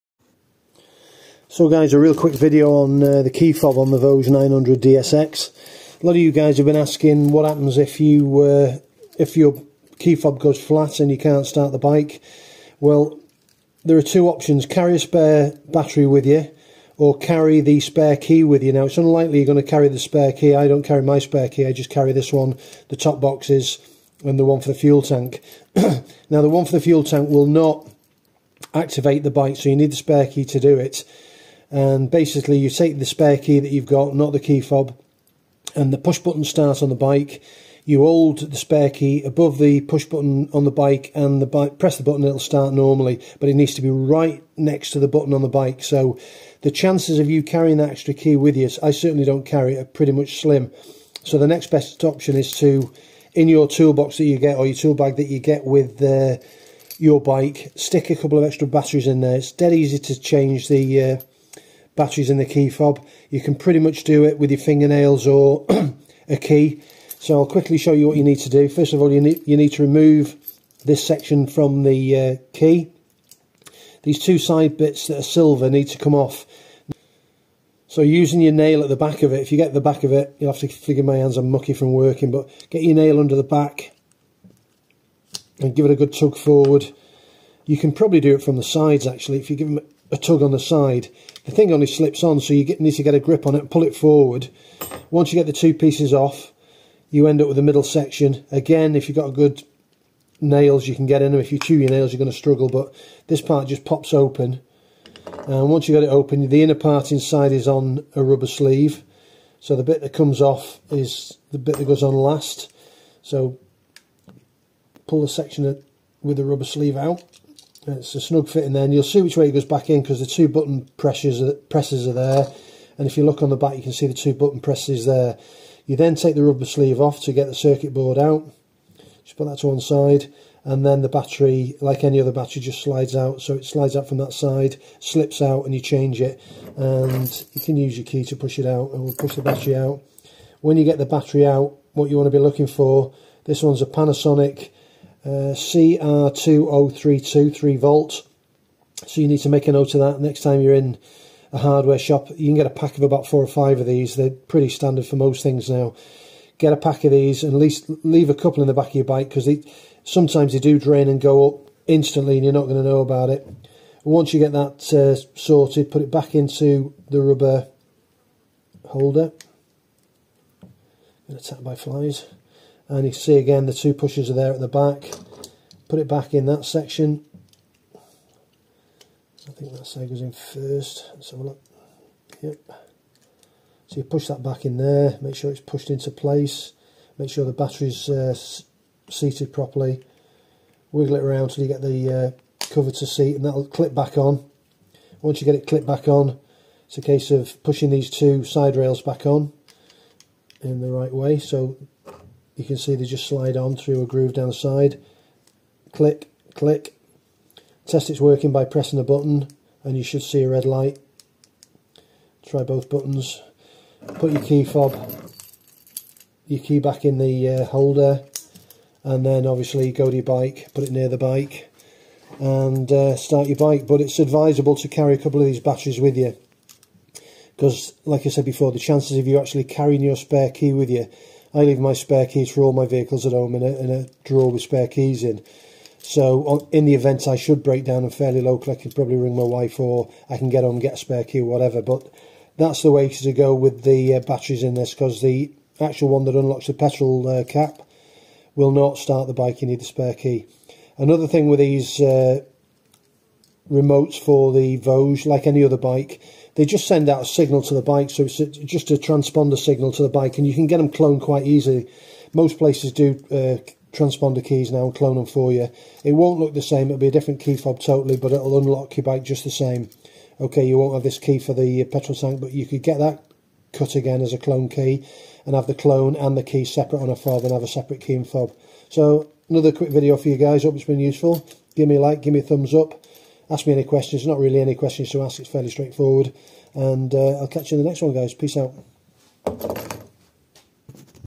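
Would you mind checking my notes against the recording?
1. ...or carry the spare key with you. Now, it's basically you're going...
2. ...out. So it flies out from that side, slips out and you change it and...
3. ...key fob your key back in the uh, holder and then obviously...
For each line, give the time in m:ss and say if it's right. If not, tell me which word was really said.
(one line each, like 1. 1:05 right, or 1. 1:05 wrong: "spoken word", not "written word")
1. 0:16 wrong: "unlikely", not "basically"
2. 2:13 wrong: "slides", not "flies"
3. 3:34 right.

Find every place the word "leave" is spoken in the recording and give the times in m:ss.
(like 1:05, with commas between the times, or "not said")
2:38, 3:51.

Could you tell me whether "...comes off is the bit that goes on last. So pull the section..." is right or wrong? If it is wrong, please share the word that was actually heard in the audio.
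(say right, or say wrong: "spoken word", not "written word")
right.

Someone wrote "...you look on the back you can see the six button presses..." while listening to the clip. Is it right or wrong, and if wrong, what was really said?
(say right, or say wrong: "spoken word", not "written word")
wrong: "two", not "six".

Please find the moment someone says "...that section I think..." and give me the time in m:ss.
2:56.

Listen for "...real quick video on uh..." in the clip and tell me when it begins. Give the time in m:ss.
0:01.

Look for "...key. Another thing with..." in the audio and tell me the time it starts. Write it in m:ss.
4:10.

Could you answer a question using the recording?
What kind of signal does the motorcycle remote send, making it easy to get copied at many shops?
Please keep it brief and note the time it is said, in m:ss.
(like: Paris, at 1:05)
Transponder signal, at 4:18.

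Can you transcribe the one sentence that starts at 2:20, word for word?
When you get the battery out, what you want to be looking for, this one's a Panasonic CR20323 3 volt.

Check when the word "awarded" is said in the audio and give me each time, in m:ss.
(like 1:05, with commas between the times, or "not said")
not said.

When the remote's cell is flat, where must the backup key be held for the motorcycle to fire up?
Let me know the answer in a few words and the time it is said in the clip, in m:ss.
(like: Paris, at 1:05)
Above the push button, at 0:39.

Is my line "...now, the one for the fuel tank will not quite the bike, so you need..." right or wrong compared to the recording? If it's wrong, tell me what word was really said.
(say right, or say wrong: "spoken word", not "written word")
wrong: "activate", not "quite".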